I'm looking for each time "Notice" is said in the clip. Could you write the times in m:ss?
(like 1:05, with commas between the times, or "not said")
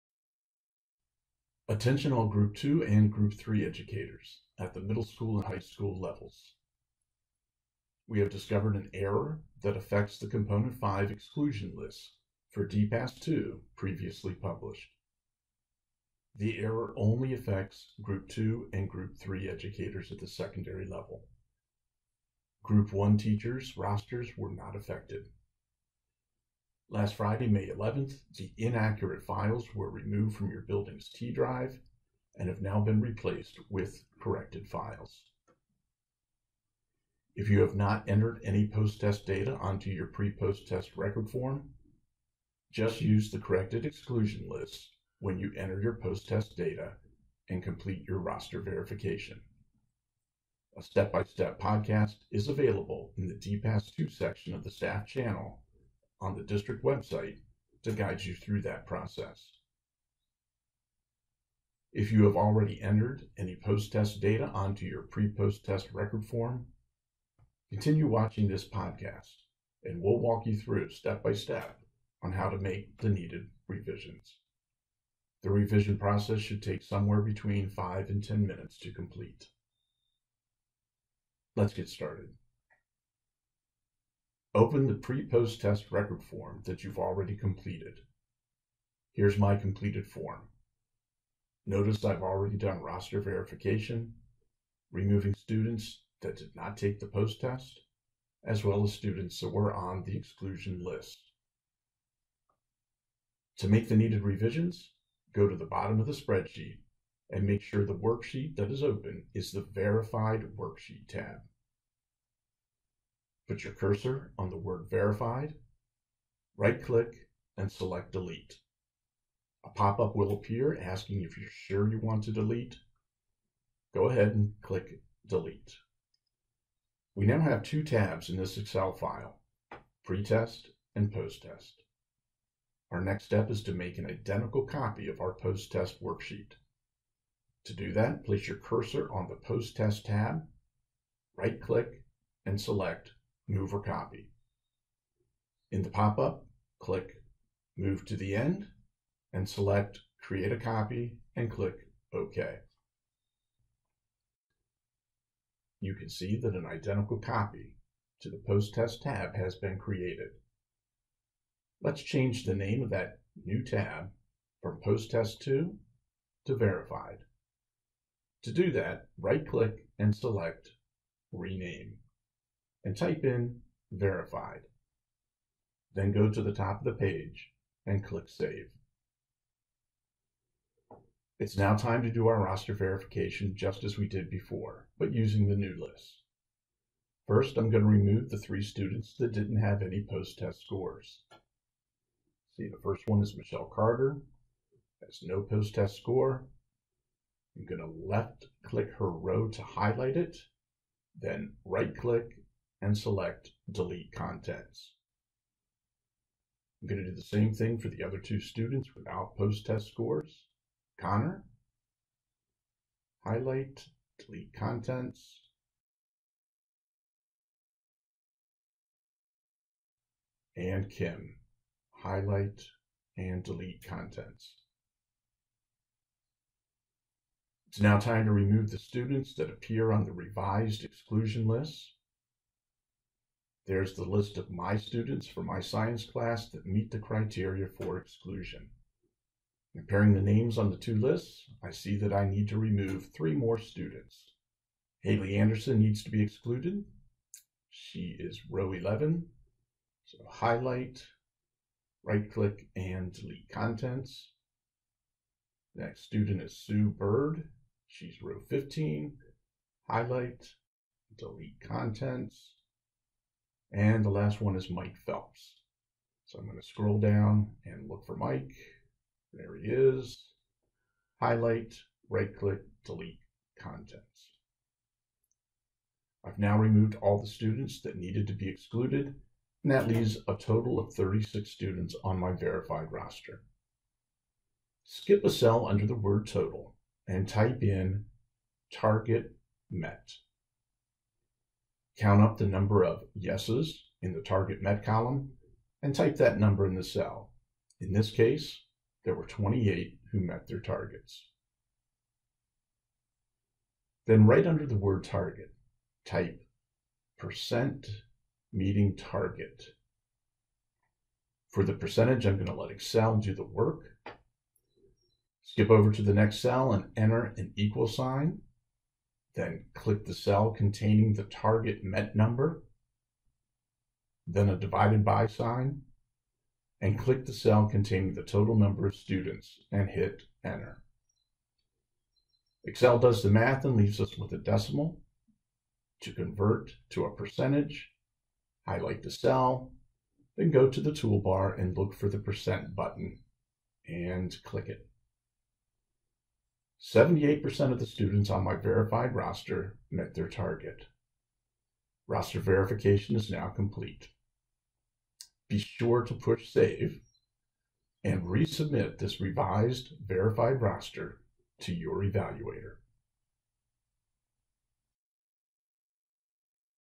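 1:31.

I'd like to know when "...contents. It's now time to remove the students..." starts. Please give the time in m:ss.
3:43.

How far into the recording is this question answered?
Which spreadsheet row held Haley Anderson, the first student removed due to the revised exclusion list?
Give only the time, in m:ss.
4:08.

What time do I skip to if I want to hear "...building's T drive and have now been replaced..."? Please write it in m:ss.
0:30.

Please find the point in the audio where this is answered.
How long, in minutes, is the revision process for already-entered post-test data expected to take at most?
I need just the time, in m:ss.
1:18.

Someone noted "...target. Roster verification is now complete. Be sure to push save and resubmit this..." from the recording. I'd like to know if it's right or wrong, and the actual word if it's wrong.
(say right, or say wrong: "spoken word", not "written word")
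right.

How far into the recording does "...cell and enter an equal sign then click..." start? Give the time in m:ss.
5:16.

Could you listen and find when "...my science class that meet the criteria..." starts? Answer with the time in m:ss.
3:55.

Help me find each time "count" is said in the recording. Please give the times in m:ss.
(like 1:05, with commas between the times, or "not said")
4:51.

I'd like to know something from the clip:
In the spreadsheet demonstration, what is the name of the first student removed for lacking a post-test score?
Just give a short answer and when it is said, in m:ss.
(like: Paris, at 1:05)
Michelle Carter, at 3:13.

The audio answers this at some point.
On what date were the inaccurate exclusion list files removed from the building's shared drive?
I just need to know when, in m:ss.
0:27.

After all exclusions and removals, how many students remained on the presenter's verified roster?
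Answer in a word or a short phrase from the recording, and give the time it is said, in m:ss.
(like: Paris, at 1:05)
36, at 4:40.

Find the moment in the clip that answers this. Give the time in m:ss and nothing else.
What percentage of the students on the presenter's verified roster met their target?
5:46.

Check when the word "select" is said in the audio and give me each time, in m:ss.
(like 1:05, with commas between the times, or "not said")
1:57, 2:22, 2:29, 2:50, 3:22.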